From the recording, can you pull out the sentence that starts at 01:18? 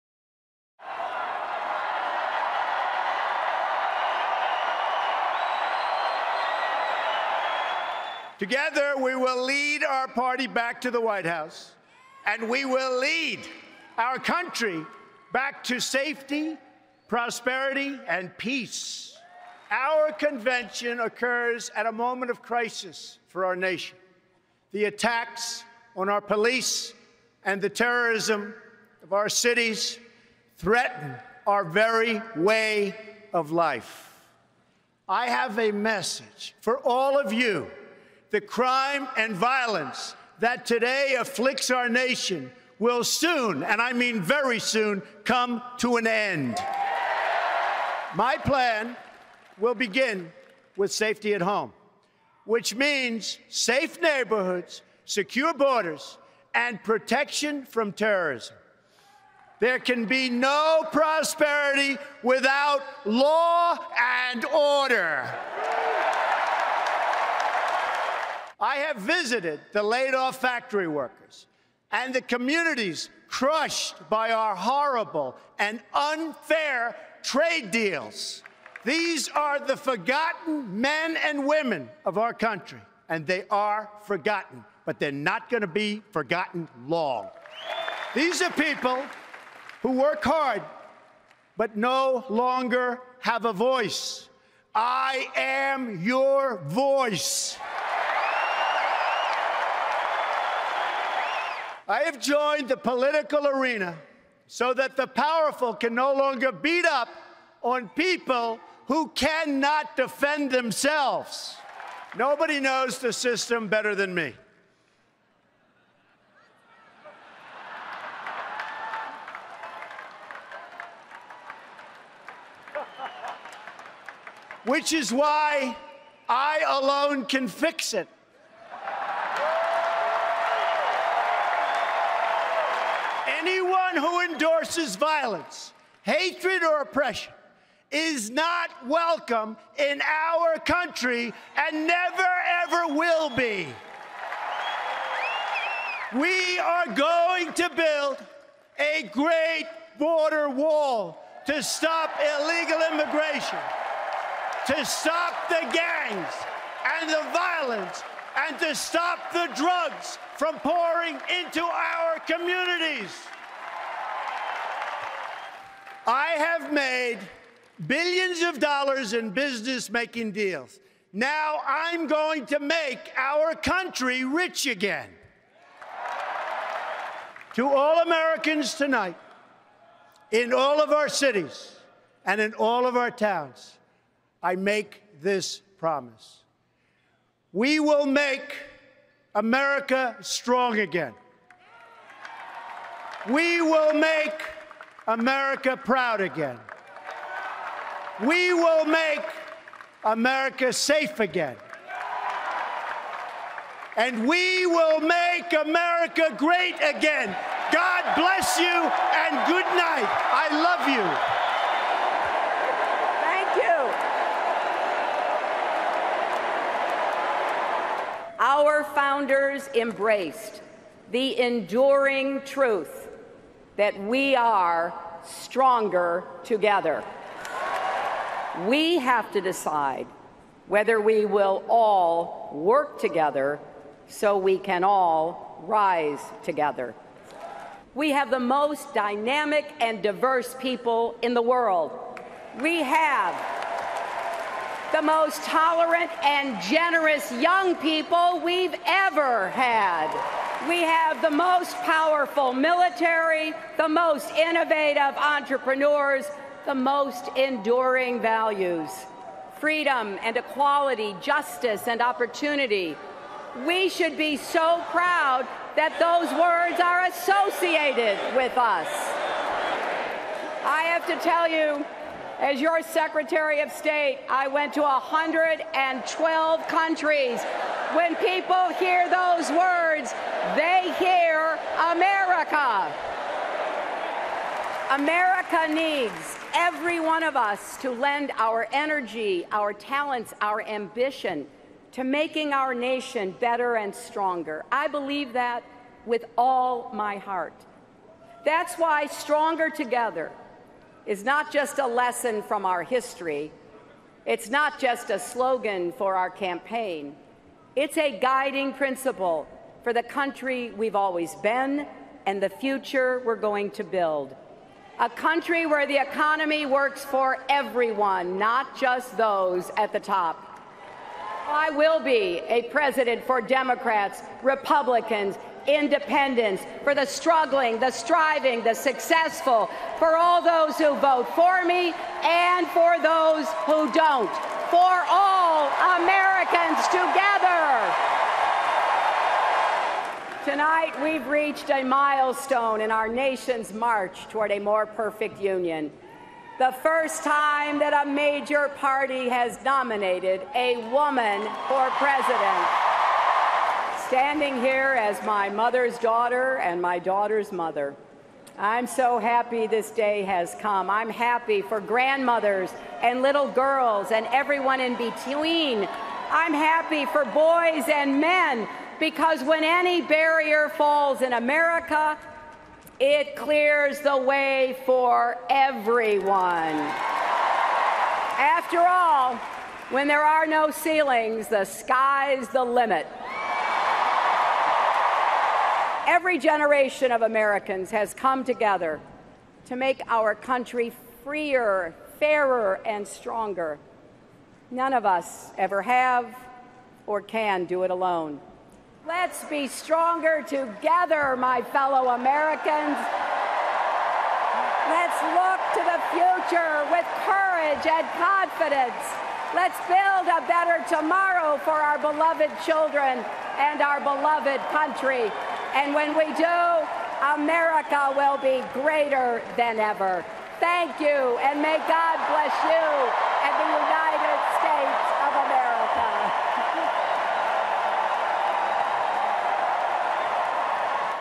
These are the forgotten men and women of our country, and they are forgotten, but they're not going to be forgotten long.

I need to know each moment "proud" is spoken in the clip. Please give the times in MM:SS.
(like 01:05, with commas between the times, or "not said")
03:15, 04:24.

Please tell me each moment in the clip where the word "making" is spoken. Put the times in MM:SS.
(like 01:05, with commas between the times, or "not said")
02:49, 04:52.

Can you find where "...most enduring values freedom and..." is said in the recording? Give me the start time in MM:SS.
04:16.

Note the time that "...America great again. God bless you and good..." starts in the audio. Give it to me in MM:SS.
03:25.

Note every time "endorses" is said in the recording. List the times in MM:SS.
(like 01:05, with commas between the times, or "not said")
02:14.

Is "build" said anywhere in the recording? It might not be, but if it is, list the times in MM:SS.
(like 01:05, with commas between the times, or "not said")
02:27, 05:13, 06:49.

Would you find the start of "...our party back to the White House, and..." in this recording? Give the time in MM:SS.
00:09.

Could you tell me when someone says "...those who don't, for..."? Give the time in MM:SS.
05:33.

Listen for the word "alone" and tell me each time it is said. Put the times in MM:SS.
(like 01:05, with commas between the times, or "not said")
02:06, 06:37.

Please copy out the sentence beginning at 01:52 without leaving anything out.
Nobody knows the system better than me.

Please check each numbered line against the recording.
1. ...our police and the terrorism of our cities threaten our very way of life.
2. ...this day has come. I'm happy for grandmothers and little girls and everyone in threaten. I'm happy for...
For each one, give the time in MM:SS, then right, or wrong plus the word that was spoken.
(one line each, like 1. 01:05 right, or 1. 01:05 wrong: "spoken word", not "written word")
1. 00:26 right
2. 05:59 wrong: "between", not "threaten".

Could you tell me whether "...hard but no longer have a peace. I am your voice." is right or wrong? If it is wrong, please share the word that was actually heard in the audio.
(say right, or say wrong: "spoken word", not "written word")
wrong: "voice", not "peace".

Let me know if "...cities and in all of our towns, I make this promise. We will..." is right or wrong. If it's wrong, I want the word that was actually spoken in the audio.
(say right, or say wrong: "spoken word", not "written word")
right.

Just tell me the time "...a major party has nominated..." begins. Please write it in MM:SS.
05:48.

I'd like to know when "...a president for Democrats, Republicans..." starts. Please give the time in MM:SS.
05:22.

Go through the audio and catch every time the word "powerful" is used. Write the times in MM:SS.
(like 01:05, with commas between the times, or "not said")
01:45, 04:11.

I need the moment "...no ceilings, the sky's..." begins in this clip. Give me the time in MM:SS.
06:20.